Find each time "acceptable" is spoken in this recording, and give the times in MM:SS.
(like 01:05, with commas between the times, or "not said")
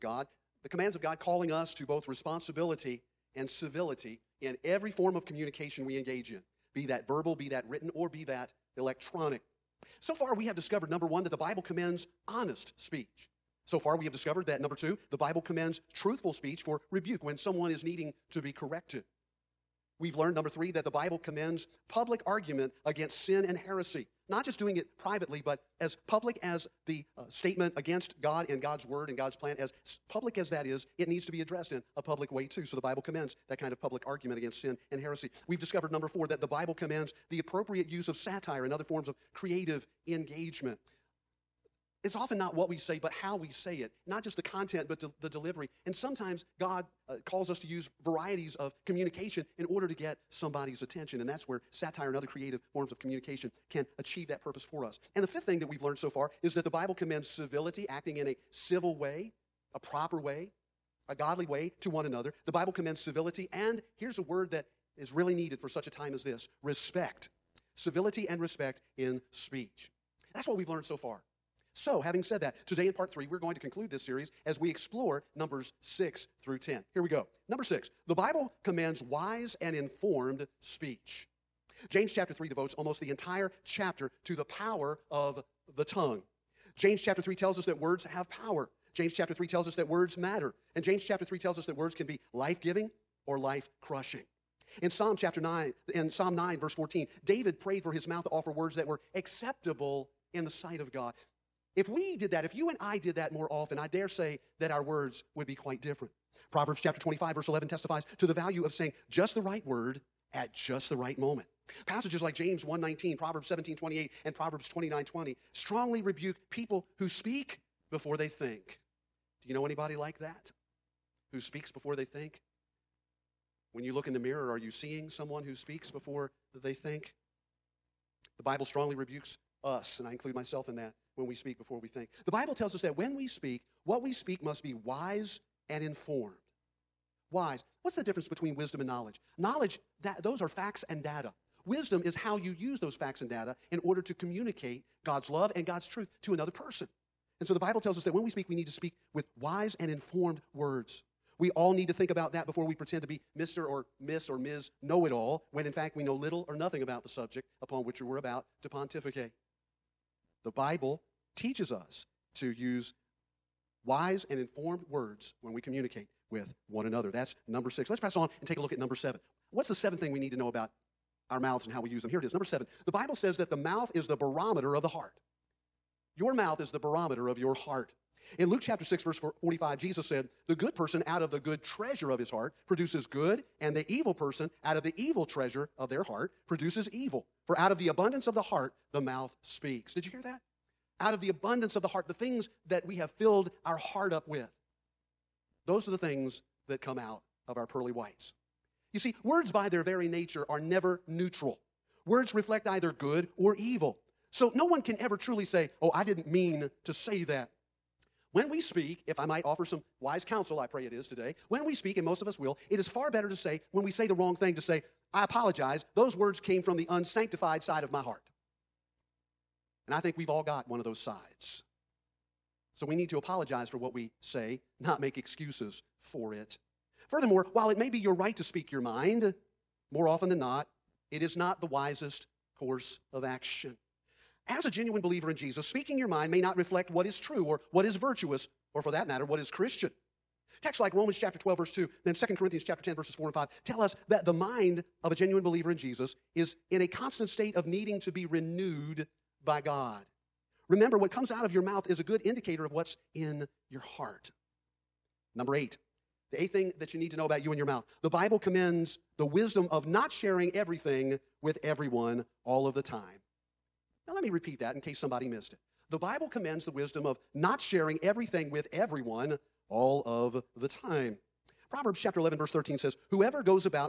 01:39.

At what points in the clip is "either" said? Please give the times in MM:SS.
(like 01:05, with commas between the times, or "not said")
03:22.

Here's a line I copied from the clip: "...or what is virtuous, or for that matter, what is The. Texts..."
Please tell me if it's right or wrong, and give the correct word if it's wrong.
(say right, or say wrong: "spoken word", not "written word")
wrong: "Christian", not "The".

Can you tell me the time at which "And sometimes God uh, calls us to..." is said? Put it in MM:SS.
00:45.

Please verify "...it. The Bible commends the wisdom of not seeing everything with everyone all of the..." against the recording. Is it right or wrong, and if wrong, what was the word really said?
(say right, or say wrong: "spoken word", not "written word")
wrong: "sharing", not "seeing".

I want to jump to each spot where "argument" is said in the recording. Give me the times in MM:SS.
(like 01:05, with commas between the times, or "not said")
00:22, 00:34.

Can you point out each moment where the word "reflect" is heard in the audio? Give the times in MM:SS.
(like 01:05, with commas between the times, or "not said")
03:22, 03:56.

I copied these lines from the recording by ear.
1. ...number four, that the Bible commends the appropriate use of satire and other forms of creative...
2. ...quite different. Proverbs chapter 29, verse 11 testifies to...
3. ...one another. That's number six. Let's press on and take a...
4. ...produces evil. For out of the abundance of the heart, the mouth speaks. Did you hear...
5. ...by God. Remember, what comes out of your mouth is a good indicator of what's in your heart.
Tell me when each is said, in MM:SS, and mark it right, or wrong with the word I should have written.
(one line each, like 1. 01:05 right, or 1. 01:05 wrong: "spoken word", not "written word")
1. 00:35 right
2. 01:45 wrong: "25", not "29"
3. 02:46 right
4. 03:06 right
5. 04:09 right.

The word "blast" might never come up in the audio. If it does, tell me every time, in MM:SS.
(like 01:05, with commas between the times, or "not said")
not said.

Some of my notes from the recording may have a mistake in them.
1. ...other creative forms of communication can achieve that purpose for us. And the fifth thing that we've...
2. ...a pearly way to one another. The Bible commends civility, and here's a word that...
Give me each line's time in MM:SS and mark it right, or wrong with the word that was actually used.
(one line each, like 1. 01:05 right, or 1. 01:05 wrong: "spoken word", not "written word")
1. 00:52 right
2. 01:01 wrong: "godly", not "pearly".